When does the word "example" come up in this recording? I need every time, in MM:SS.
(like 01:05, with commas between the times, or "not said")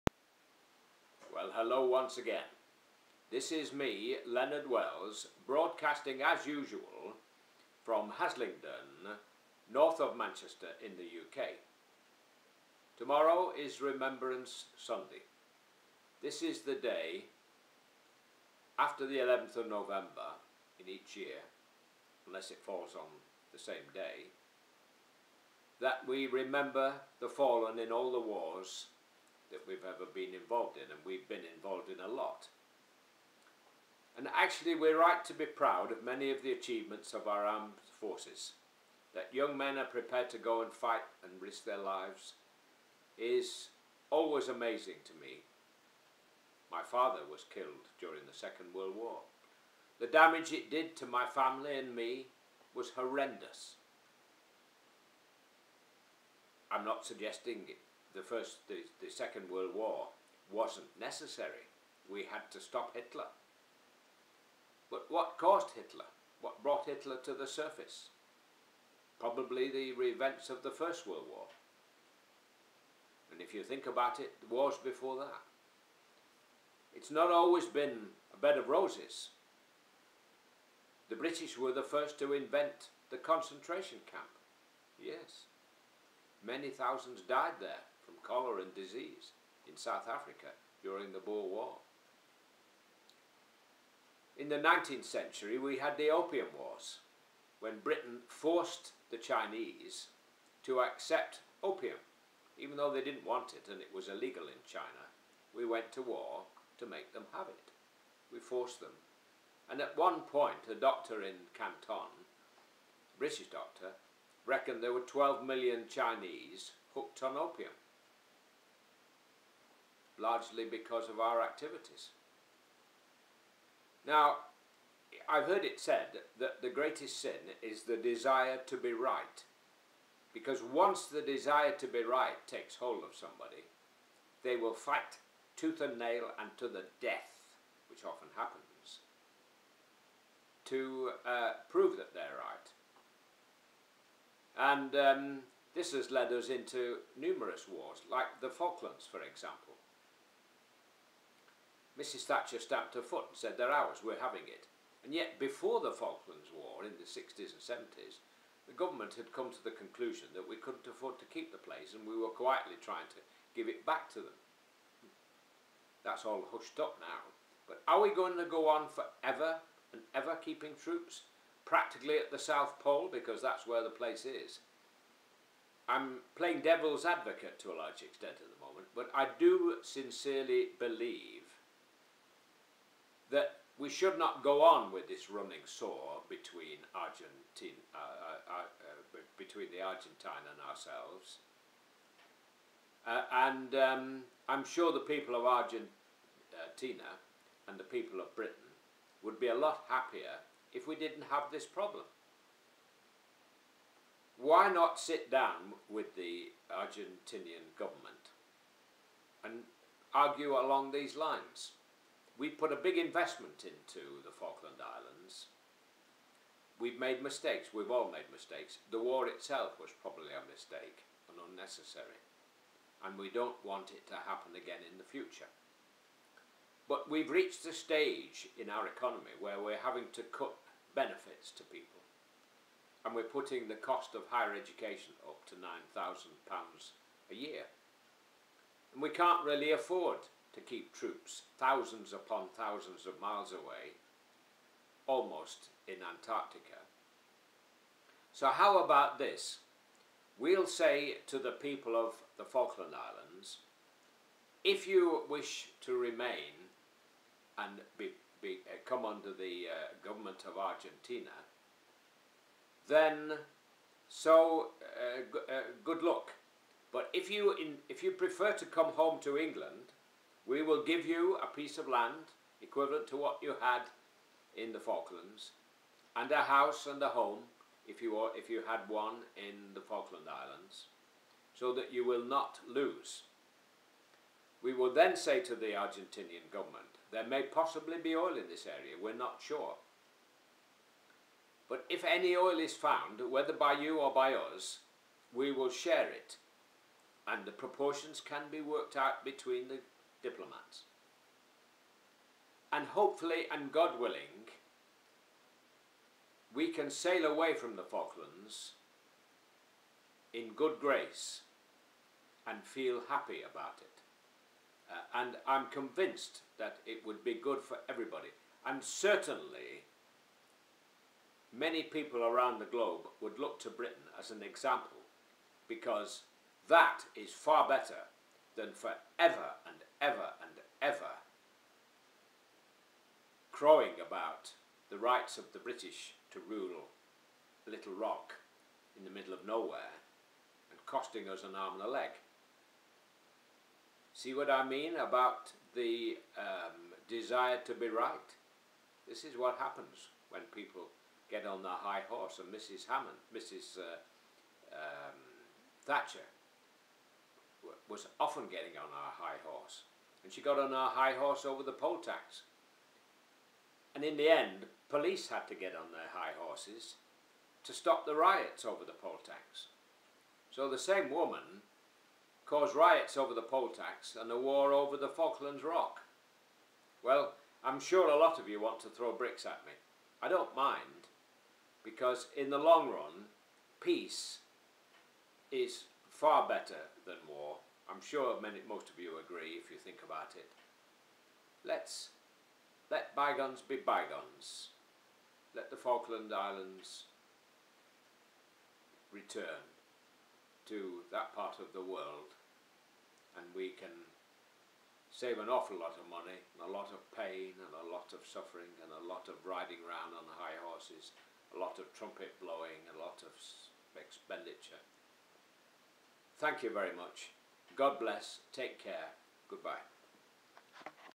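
02:29, 05:24.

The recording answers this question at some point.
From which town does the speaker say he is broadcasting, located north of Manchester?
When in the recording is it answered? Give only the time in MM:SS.
00:08.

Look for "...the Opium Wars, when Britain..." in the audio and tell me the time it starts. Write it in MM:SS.
01:35.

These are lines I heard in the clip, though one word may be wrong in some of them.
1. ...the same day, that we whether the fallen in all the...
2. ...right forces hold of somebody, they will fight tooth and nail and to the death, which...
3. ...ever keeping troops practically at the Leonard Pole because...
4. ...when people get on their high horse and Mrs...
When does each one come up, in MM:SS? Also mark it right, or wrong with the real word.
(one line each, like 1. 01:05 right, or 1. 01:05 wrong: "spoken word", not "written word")
1. 00:23 wrong: "remember", not "whether"
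2. 02:12 wrong: "takes", not "forces"
3. 02:50 wrong: "South", not "Leonard"
4. 05:50 right.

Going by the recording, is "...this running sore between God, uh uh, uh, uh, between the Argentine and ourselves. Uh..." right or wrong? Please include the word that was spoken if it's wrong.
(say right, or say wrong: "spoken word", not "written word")
wrong: "Argentine", not "God".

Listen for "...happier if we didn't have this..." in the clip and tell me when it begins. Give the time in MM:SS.
03:19.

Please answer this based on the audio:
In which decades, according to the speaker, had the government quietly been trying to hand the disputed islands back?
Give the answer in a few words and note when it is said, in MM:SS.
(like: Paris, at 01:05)
60s and 70s, at 02:37.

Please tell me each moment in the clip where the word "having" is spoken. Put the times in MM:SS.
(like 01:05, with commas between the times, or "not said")
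02:34, 03:49.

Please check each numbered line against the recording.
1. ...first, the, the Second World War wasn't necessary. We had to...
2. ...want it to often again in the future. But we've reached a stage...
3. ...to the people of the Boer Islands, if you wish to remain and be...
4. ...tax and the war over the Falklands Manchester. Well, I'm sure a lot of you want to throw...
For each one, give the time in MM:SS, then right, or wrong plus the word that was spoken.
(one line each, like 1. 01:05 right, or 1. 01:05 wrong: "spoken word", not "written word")
1. 00:58 right
2. 03:43 wrong: "happen", not "often"
3. 04:11 wrong: "Falkland", not "Boer"
4. 06:13 wrong: "Rock", not "Manchester".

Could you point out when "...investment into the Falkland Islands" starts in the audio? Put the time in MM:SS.
03:32.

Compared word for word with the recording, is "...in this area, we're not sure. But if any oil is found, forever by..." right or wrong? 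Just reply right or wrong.
wrong.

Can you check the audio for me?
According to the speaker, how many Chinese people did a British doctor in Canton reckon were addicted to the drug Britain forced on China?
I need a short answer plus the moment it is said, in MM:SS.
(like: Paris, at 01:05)
12 million, at 01:55.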